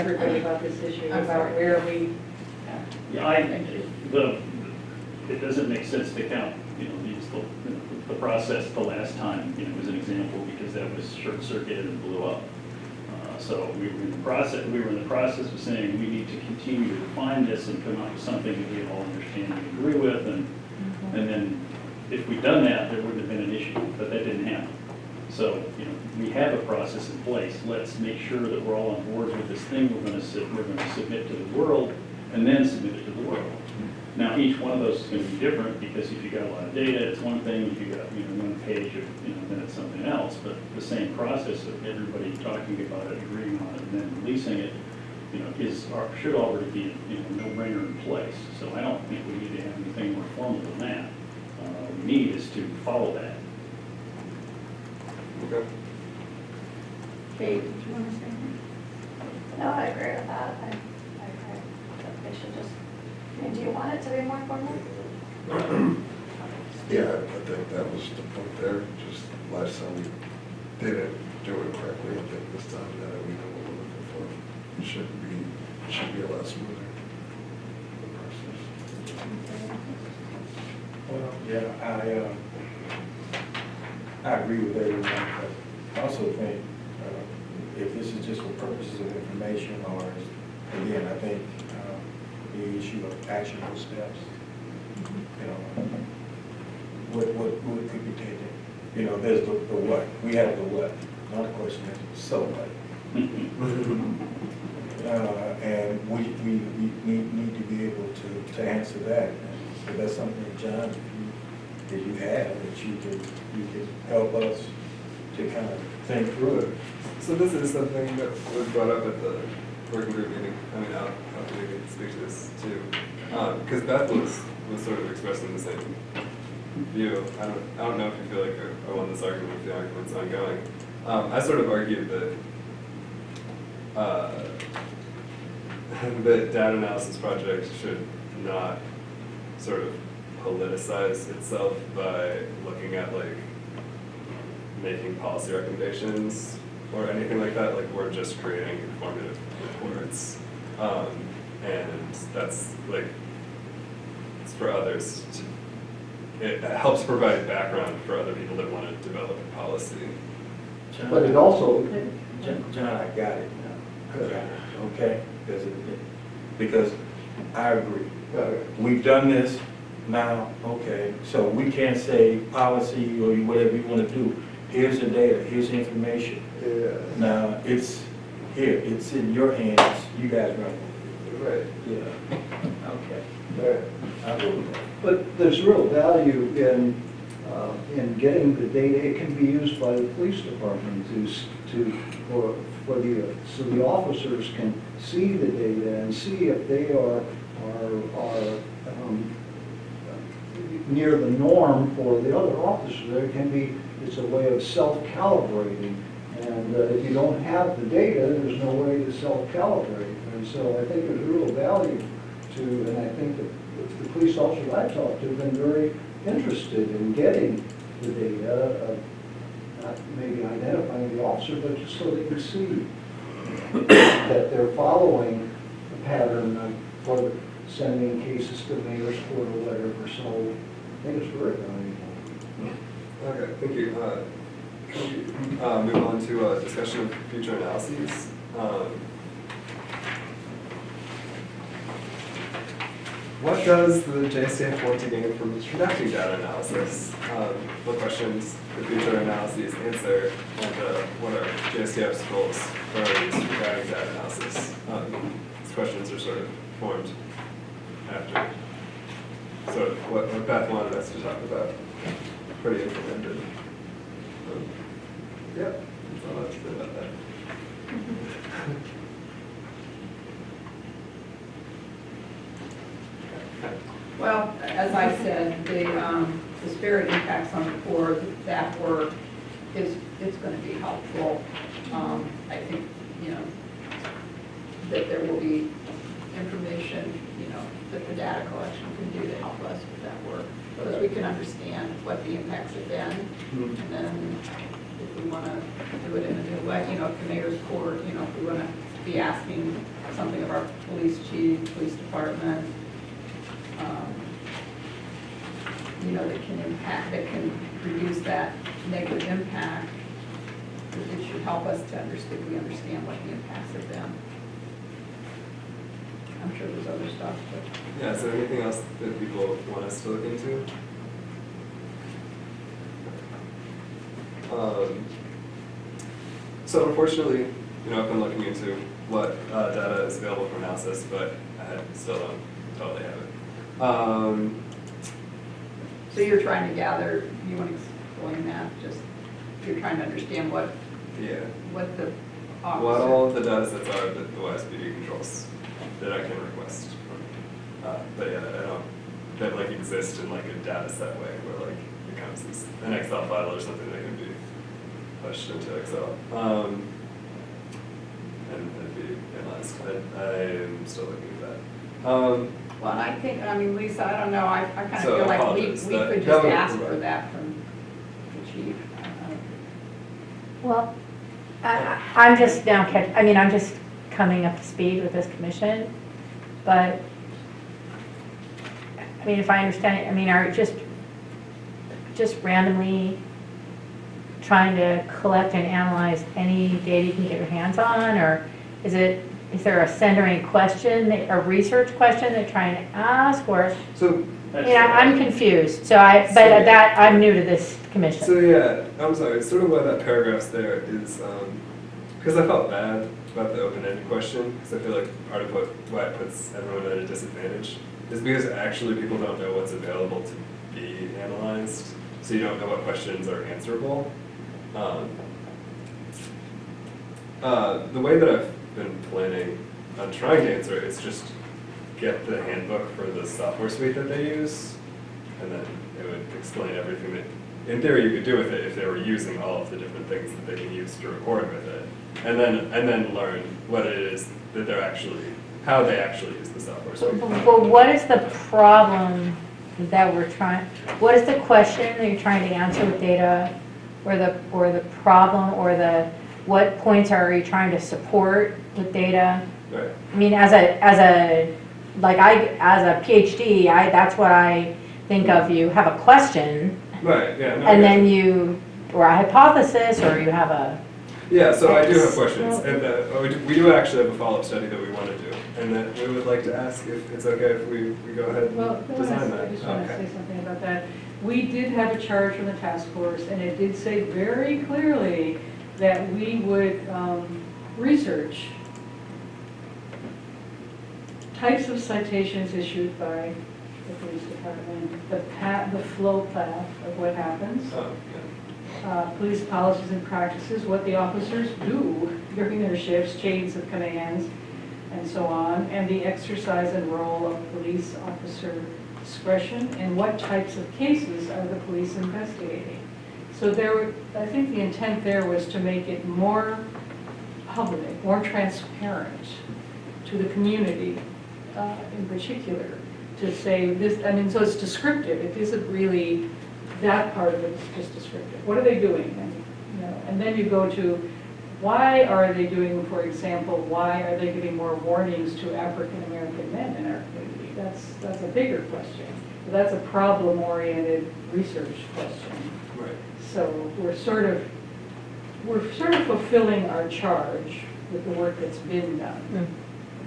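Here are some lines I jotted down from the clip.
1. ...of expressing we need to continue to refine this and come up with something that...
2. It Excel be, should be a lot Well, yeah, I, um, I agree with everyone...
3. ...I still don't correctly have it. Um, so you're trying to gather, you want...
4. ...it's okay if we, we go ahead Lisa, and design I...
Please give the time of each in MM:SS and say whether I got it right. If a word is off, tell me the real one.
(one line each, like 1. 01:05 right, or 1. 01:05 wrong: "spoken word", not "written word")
1. 00:15 wrong: "saying", not "expressing"
2. 01:14 wrong: "Should", not "Excel"
3. 05:31 wrong: "totally", not "correctly"
4. 07:47 wrong: "Well", not "Lisa".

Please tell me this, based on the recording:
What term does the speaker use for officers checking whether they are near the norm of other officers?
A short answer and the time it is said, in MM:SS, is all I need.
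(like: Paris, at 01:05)
self-calibrating, at 03:24.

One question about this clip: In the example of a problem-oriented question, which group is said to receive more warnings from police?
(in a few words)
African American men.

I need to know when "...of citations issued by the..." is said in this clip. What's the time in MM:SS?
08:01.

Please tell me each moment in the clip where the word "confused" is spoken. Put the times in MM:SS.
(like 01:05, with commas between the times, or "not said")
06:35.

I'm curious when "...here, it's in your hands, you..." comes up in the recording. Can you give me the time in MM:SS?
02:58.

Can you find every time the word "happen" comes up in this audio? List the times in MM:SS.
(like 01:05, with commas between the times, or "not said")
00:24, 08:07.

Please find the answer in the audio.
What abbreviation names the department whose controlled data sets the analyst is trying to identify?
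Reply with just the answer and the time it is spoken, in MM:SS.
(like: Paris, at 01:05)
YSPD, at 05:44.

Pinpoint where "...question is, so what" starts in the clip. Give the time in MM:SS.
01:41.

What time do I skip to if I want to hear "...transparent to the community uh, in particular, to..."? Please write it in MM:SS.
08:28.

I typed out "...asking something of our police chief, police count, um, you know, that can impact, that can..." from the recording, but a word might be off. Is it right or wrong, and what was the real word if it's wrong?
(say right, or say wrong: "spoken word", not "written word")
wrong: "department", not "count".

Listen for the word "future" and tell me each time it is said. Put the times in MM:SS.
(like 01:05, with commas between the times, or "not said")
03:57, 04:08.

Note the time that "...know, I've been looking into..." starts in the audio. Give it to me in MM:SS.
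05:27.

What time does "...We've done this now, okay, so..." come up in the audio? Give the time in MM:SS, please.
02:48.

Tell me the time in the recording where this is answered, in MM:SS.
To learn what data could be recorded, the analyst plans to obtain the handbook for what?
07:03.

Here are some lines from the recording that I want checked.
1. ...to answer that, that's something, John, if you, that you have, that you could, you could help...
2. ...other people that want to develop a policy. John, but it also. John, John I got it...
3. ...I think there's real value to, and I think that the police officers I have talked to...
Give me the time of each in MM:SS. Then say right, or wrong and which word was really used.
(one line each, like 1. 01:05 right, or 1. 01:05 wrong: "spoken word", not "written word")
1. 01:48 right
2. 02:38 right
3. 03:30 right.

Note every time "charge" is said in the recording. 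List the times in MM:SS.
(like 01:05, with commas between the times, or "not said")
07:52, 08:56.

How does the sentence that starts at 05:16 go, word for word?
I'm sure there's other stuff, but.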